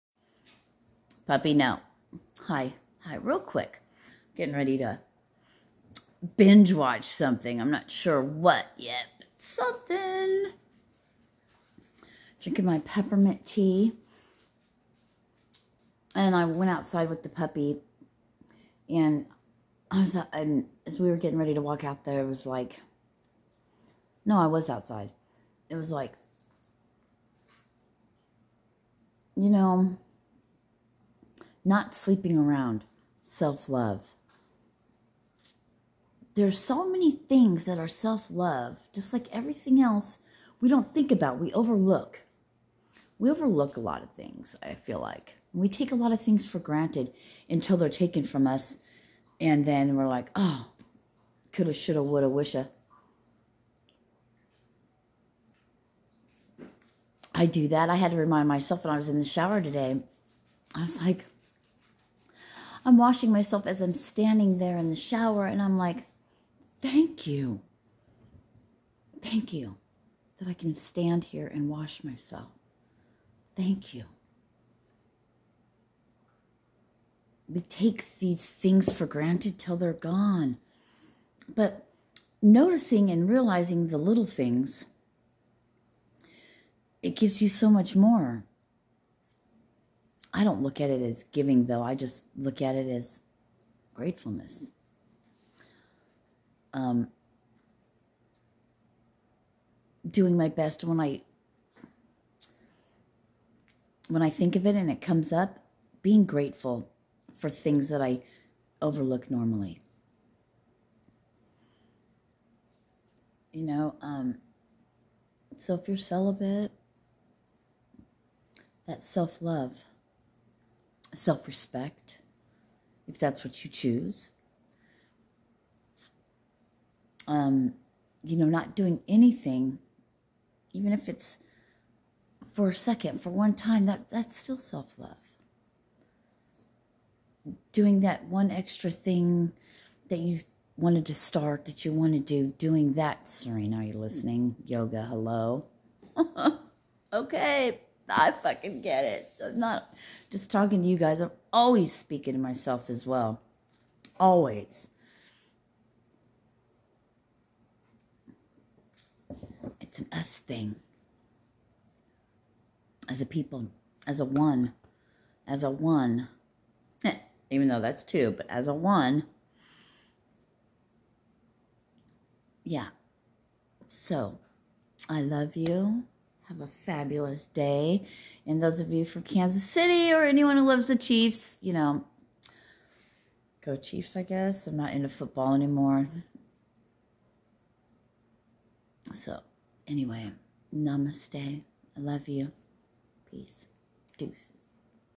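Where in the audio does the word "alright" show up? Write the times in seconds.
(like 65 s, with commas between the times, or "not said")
not said.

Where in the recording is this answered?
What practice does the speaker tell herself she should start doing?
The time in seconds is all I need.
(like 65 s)
144 s.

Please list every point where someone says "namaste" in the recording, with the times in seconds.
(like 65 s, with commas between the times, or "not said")
190 s.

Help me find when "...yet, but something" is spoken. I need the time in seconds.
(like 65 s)
8 s.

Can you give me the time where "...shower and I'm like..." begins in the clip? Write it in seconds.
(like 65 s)
64 s.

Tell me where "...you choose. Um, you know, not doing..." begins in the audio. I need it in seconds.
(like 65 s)
123 s.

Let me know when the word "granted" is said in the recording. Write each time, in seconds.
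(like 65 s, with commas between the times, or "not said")
46 s, 79 s.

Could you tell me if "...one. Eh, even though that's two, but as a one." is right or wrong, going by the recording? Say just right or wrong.
right.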